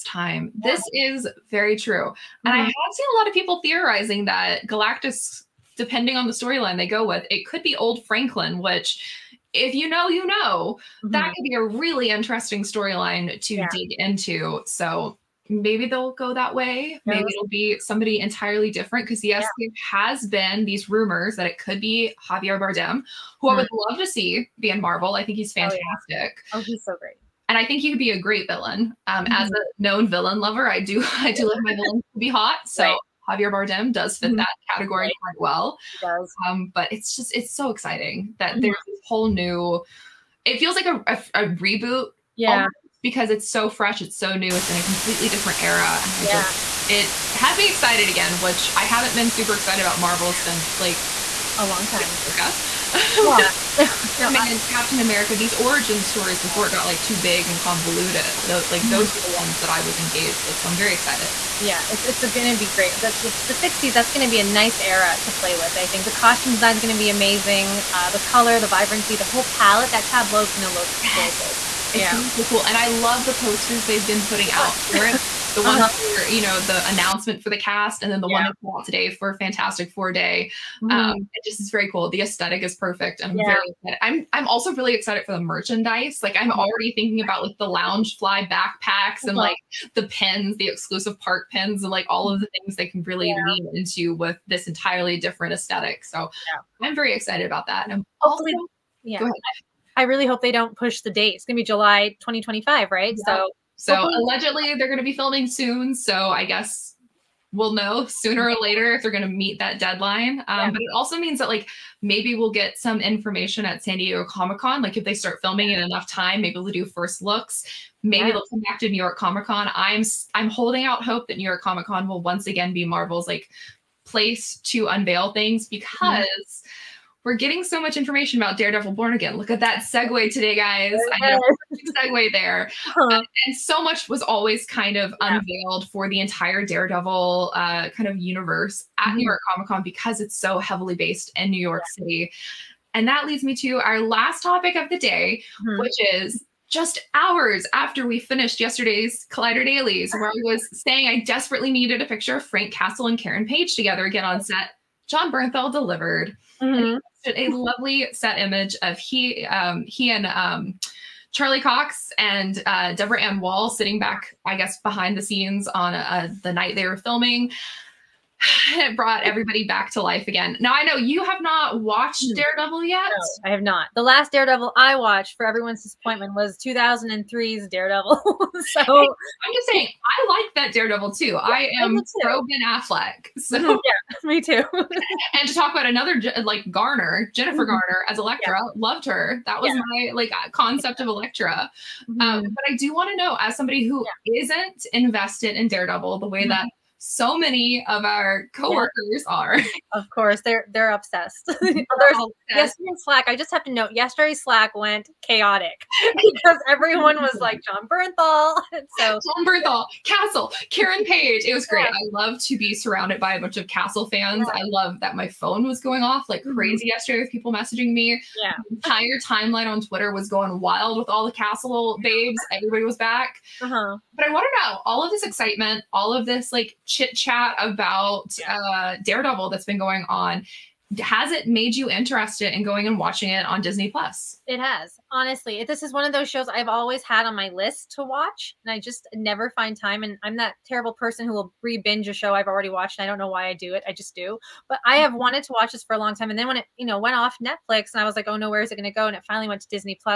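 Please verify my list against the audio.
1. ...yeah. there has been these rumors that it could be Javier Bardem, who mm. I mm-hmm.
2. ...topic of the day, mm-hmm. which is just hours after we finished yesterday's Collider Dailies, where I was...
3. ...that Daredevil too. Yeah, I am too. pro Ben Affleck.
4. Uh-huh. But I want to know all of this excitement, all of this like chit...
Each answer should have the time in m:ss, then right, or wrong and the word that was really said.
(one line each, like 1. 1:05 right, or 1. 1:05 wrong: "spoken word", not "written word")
1. 0:19 right
2. 2:24 right
3. 3:00 right
4. 3:43 right.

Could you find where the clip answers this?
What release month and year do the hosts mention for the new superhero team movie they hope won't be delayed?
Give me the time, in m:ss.
1:41.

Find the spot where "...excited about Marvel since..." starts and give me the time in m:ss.
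0:49.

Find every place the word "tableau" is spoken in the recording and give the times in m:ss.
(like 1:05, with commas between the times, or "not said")
1:10.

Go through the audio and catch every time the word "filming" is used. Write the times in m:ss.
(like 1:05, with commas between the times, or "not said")
1:45, 1:55, 2:46.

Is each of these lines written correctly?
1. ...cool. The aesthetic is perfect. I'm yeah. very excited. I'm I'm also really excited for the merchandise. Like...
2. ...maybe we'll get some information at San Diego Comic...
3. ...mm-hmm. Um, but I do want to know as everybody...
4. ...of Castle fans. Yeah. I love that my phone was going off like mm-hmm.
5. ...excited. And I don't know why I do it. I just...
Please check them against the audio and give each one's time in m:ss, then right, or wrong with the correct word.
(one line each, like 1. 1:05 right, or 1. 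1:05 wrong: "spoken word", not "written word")
1. 1:21 right
2. 1:52 right
3. 3:12 wrong: "somebody", not "everybody"
4. 3:33 right
5. 4:02 wrong: "watched", not "excited".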